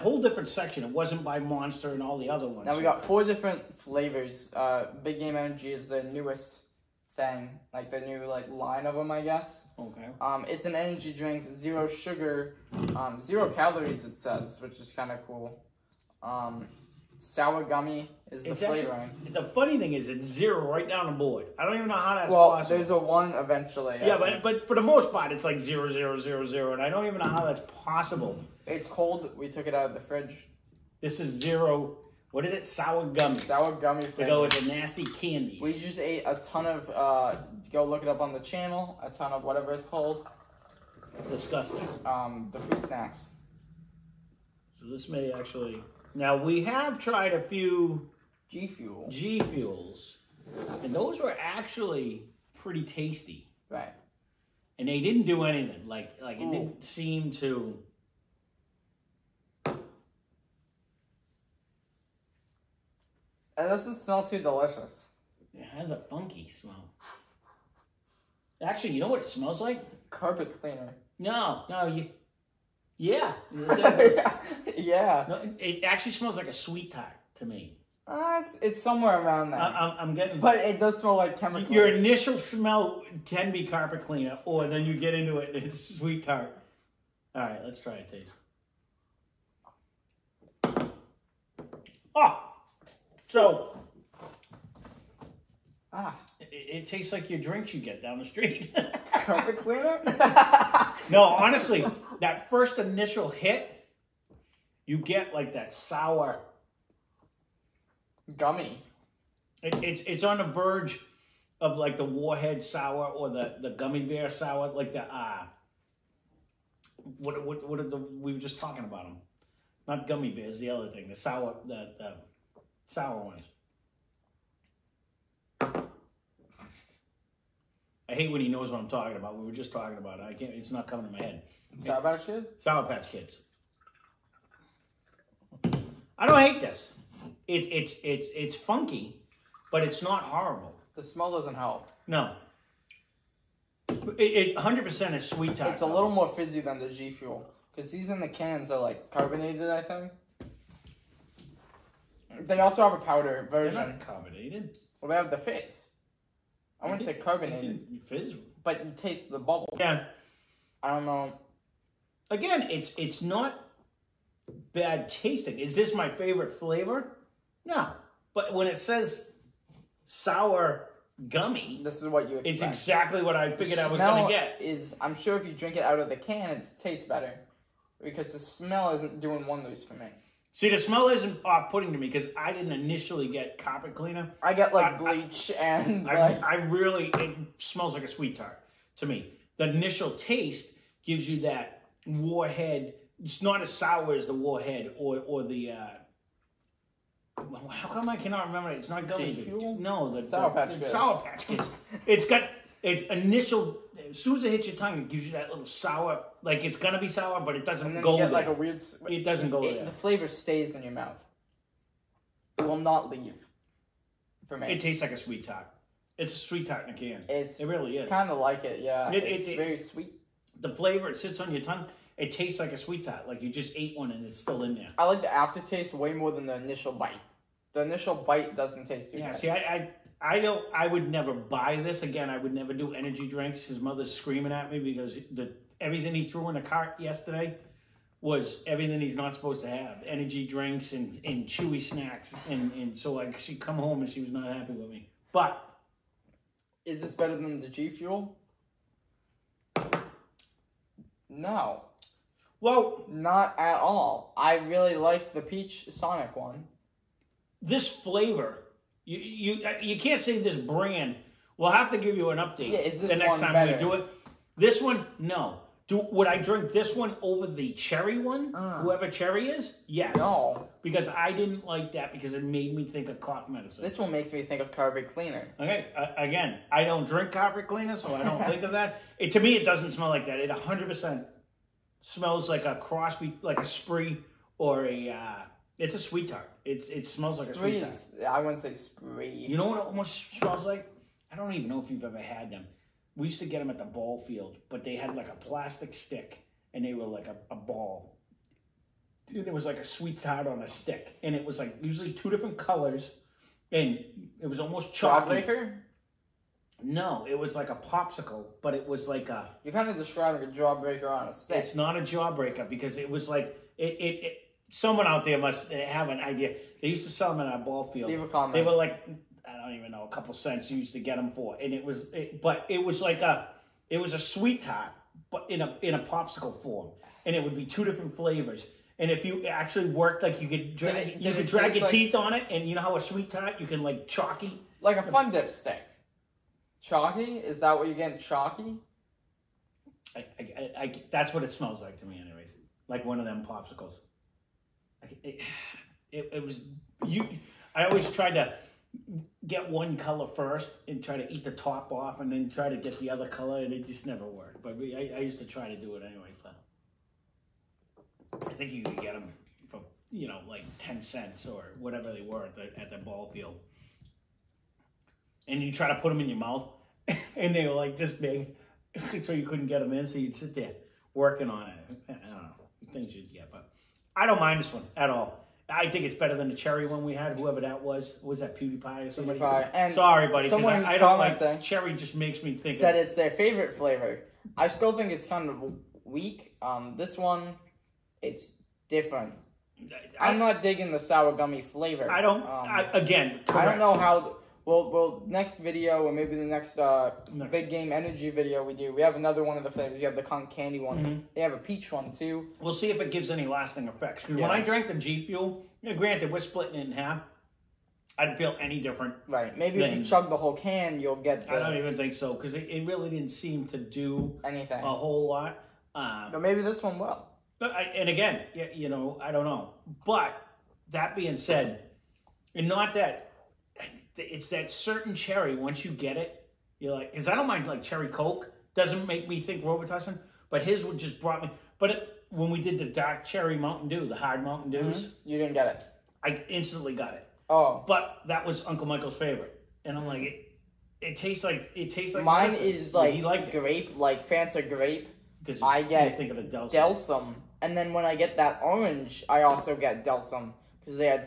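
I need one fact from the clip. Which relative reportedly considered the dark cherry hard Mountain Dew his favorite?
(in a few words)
Uncle Michael.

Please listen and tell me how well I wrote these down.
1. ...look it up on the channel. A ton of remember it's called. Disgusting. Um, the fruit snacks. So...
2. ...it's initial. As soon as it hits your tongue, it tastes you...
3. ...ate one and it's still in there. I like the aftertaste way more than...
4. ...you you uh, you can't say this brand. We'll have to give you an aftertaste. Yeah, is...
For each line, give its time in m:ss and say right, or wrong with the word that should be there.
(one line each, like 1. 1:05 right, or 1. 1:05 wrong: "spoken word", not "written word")
1. 0:37 wrong: "whatever", not "remember"
2. 3:22 wrong: "gives", not "tastes"
3. 3:43 right
4. 4:19 wrong: "update", not "aftertaste".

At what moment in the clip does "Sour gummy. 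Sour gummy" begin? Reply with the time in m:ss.
0:32.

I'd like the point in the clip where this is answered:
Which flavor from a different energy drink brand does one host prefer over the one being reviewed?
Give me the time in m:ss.
4:15.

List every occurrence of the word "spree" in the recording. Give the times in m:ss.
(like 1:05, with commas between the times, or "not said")
4:43, 4:48.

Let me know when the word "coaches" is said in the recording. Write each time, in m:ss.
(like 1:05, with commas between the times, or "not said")
not said.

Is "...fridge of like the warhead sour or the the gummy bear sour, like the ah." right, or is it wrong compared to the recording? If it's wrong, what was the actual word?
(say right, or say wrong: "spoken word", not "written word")
wrong: "verge", not "fridge".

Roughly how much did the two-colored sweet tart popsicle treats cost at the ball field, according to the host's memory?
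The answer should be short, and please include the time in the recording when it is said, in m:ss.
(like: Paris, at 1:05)
10 cents, at 6:00.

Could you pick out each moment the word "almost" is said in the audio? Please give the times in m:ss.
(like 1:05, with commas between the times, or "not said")
4:49, 5:04.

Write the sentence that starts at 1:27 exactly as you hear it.
All right, let's try a taste.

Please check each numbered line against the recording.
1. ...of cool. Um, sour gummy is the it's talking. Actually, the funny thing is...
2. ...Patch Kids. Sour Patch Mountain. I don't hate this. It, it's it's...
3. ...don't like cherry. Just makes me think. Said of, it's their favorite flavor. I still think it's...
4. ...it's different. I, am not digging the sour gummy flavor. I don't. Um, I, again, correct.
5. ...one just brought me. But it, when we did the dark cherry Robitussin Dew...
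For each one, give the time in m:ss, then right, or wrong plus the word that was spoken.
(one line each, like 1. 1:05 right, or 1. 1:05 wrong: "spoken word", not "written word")
1. 0:15 wrong: "flavoring", not "talking"
2. 2:12 wrong: "Kids", not "Mountain"
3. 6:20 right
4. 6:28 right
5. 7:10 wrong: "Mountain", not "Robitussin".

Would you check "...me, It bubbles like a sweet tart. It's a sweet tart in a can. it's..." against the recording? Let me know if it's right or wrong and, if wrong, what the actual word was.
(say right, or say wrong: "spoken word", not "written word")
wrong: "tastes", not "bubbles".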